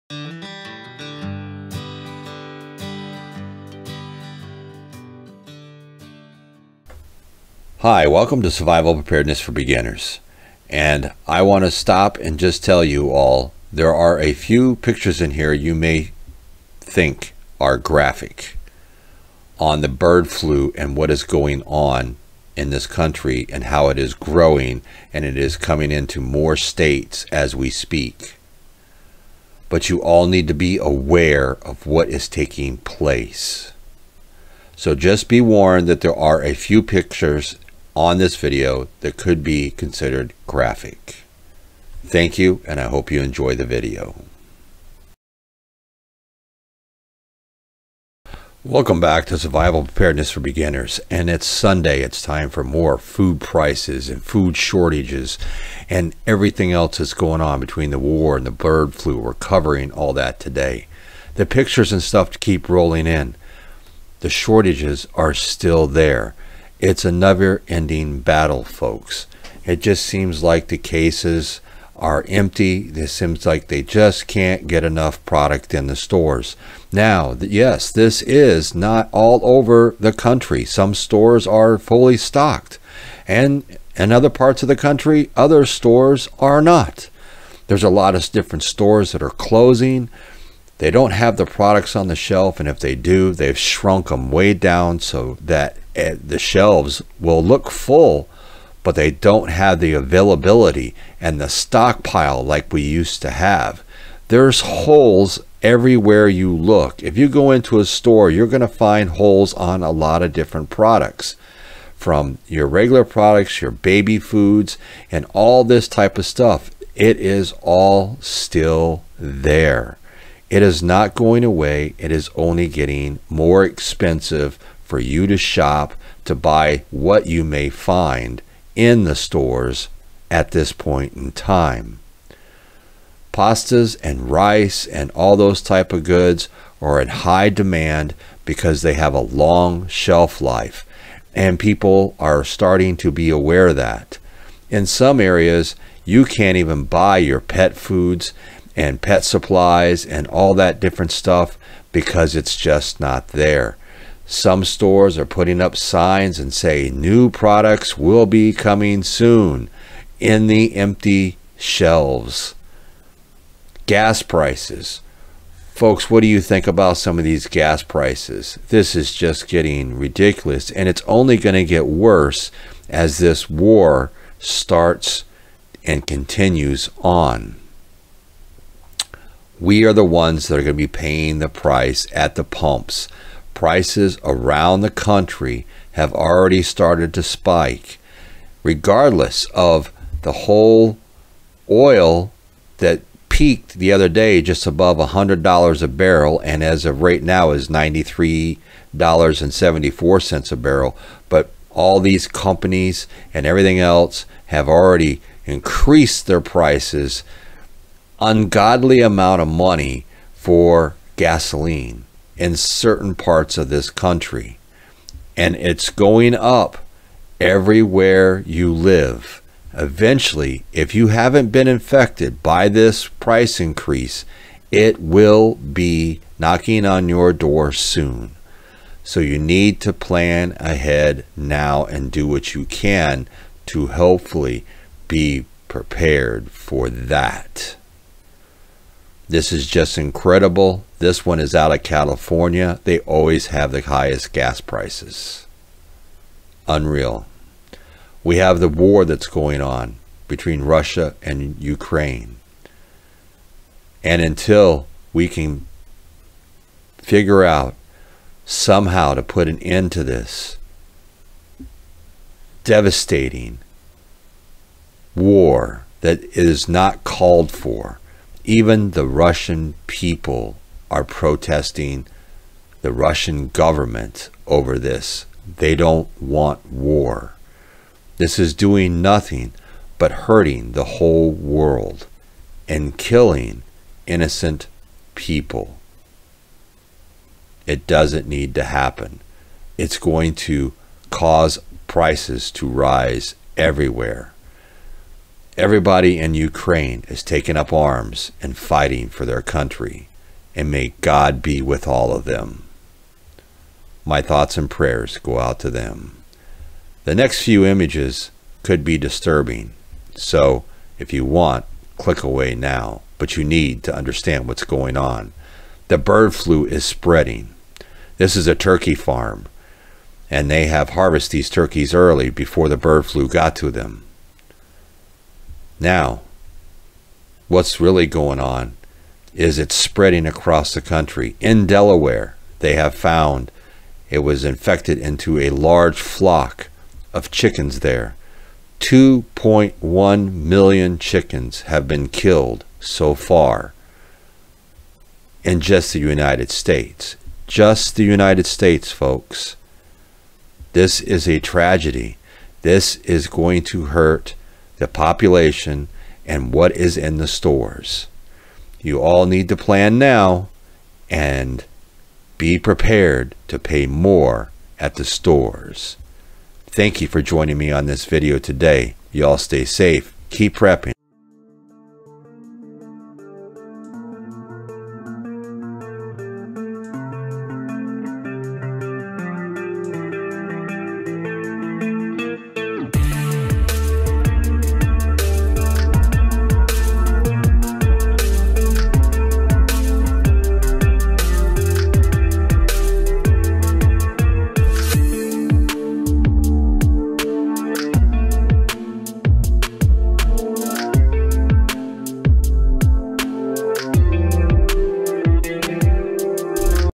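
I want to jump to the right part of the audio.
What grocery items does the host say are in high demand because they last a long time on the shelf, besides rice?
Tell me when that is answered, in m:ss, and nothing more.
2:13.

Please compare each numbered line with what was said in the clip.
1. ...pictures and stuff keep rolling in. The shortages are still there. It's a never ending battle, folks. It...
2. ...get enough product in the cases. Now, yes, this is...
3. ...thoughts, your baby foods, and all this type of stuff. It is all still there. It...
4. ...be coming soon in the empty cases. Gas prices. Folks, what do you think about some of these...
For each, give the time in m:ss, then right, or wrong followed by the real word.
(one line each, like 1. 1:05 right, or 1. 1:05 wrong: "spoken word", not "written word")
1. 1:01 right
2. 1:14 wrong: "stores", not "cases"
3. 1:53 wrong: "products", not "thoughts"
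4. 2:38 wrong: "shelves", not "cases".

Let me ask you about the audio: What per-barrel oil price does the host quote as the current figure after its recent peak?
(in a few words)
$93.74.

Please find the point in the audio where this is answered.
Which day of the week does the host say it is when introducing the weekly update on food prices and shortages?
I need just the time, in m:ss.
0:51.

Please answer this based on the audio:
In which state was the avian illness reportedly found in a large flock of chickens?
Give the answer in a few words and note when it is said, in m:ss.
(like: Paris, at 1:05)
Delaware, at 5:31.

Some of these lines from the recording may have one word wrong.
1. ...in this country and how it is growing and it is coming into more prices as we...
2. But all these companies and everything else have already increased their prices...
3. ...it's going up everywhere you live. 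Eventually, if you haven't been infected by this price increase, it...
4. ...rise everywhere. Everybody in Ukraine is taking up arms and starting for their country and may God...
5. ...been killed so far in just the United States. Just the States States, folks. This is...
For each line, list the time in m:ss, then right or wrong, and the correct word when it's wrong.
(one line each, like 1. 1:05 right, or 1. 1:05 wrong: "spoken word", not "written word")
1. 0:22 wrong: "states", not "prices"
2. 3:21 right
3. 3:35 right
4. 4:52 wrong: "fighting", not "starting"
5. 5:41 wrong: "United", not "States".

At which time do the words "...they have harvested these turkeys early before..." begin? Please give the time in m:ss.
5:20.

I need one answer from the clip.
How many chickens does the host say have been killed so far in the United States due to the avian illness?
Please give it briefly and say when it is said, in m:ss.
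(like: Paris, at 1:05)
2.1 million, at 5:38.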